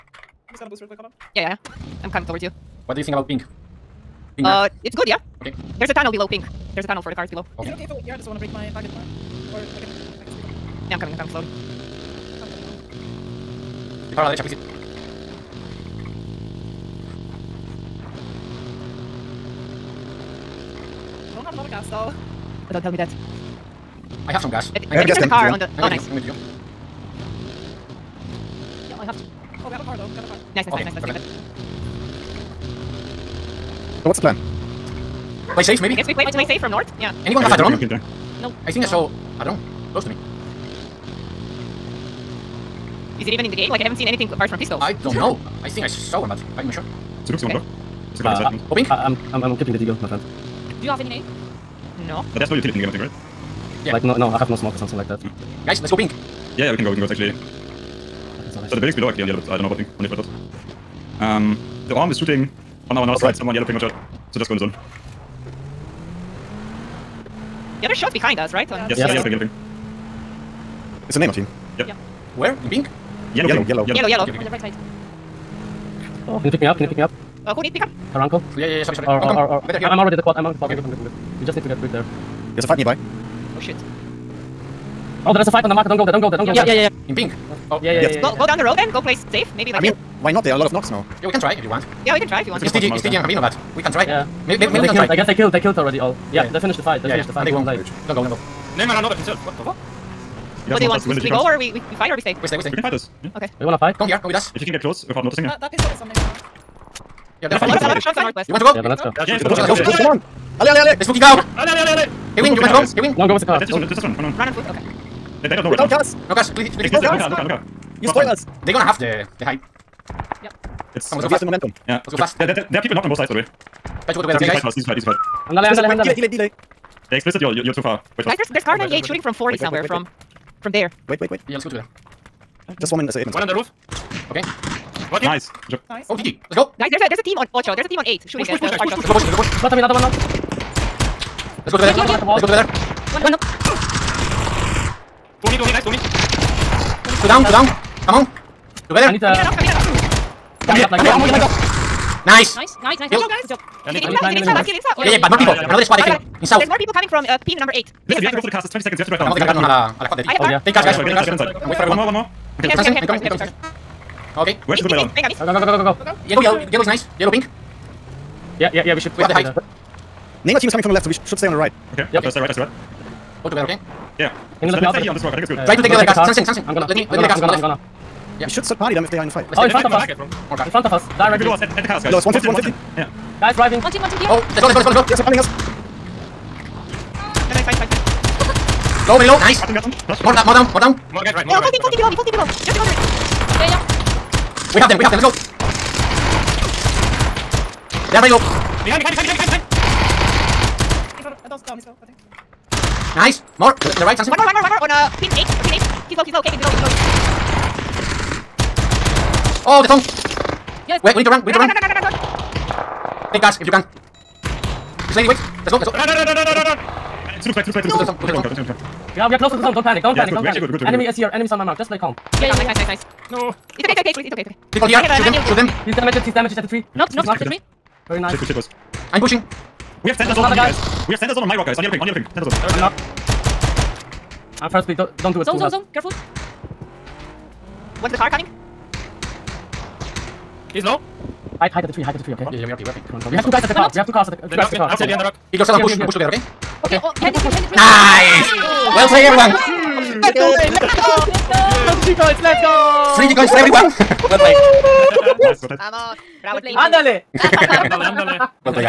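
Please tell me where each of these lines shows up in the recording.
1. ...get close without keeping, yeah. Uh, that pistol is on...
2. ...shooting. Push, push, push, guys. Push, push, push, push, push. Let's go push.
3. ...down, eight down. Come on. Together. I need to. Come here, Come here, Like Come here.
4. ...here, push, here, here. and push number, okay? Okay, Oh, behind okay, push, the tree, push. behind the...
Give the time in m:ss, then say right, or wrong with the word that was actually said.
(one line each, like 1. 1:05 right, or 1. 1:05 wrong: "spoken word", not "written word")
1. 1:44 wrong: "noticing", not "keeping"
2. 2:18 right
3. 2:27 wrong: "two", not "eight"
4. 4:05 wrong: "together", not "number".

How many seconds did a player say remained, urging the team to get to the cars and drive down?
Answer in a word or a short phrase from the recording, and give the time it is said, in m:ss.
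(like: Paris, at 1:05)
20, at 2:38.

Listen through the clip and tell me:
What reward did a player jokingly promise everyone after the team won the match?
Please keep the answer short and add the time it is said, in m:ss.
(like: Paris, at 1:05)
3D coins, at 4:13.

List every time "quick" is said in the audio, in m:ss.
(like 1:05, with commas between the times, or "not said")
0:00, 1:21.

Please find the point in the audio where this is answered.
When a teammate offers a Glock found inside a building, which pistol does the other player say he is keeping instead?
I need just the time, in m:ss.
0:49.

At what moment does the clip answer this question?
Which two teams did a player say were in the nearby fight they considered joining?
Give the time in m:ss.
1:33.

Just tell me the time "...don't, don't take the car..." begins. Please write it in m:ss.
3:38.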